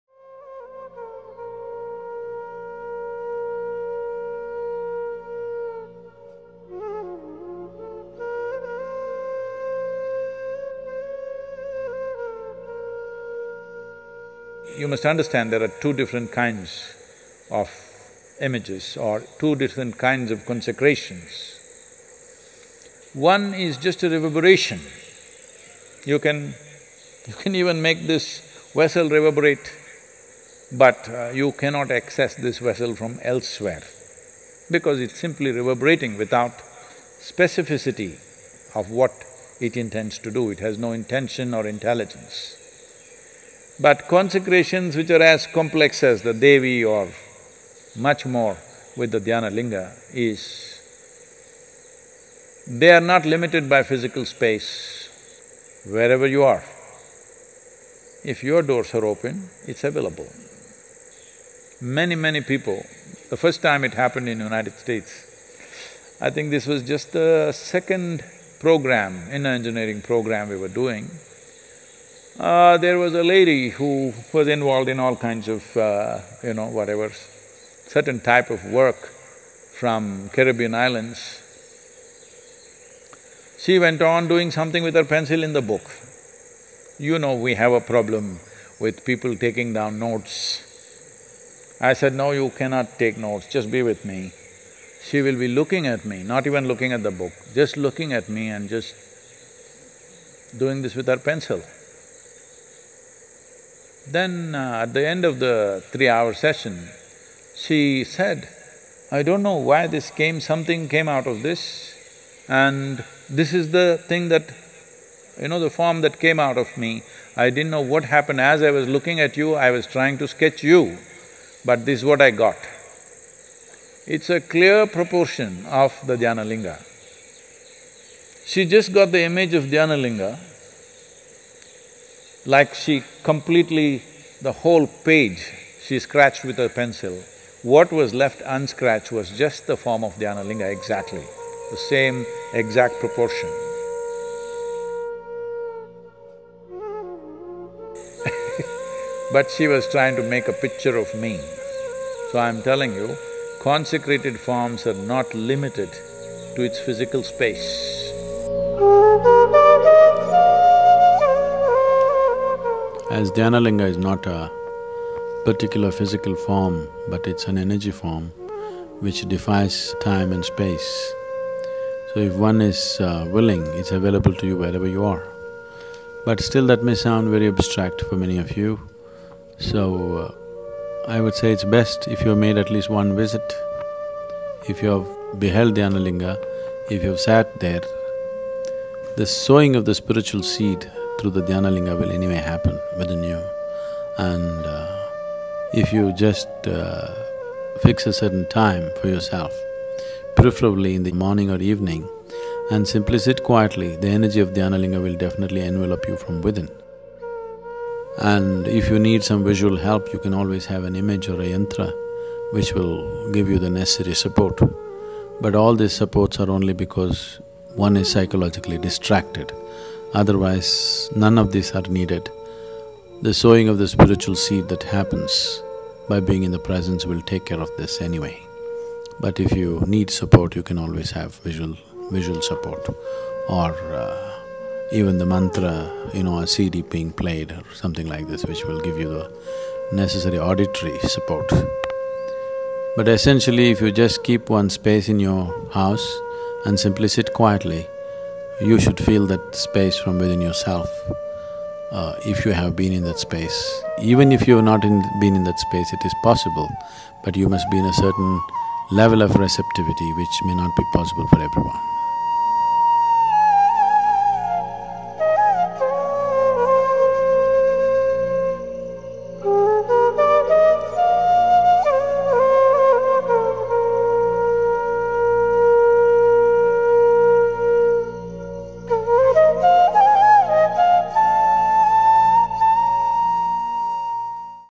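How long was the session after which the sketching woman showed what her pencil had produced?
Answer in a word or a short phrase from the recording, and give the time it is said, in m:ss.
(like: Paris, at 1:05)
3 hours, at 1:45.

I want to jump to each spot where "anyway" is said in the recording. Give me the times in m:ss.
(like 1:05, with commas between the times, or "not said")
3:12, 3:48.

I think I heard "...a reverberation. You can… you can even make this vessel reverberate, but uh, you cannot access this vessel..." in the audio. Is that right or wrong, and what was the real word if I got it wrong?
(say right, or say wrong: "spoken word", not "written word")
right.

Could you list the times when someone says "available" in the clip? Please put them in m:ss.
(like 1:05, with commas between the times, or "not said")
0:59, 2:53.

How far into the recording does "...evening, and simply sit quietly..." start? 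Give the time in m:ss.
3:21.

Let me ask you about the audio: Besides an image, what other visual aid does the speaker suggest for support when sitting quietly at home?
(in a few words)
a yantra.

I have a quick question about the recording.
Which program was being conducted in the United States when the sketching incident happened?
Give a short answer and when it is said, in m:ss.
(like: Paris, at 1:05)
Inner Engineering, at 1:09.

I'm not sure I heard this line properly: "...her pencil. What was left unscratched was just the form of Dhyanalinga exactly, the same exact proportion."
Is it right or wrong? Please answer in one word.
right.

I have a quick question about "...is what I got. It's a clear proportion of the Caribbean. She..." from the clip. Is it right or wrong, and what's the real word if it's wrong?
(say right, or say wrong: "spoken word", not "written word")
wrong: "Dhyanalinga", not "Caribbean".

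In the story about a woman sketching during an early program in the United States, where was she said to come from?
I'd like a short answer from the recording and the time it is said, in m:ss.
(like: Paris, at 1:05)
Caribbean islands, at 1:20.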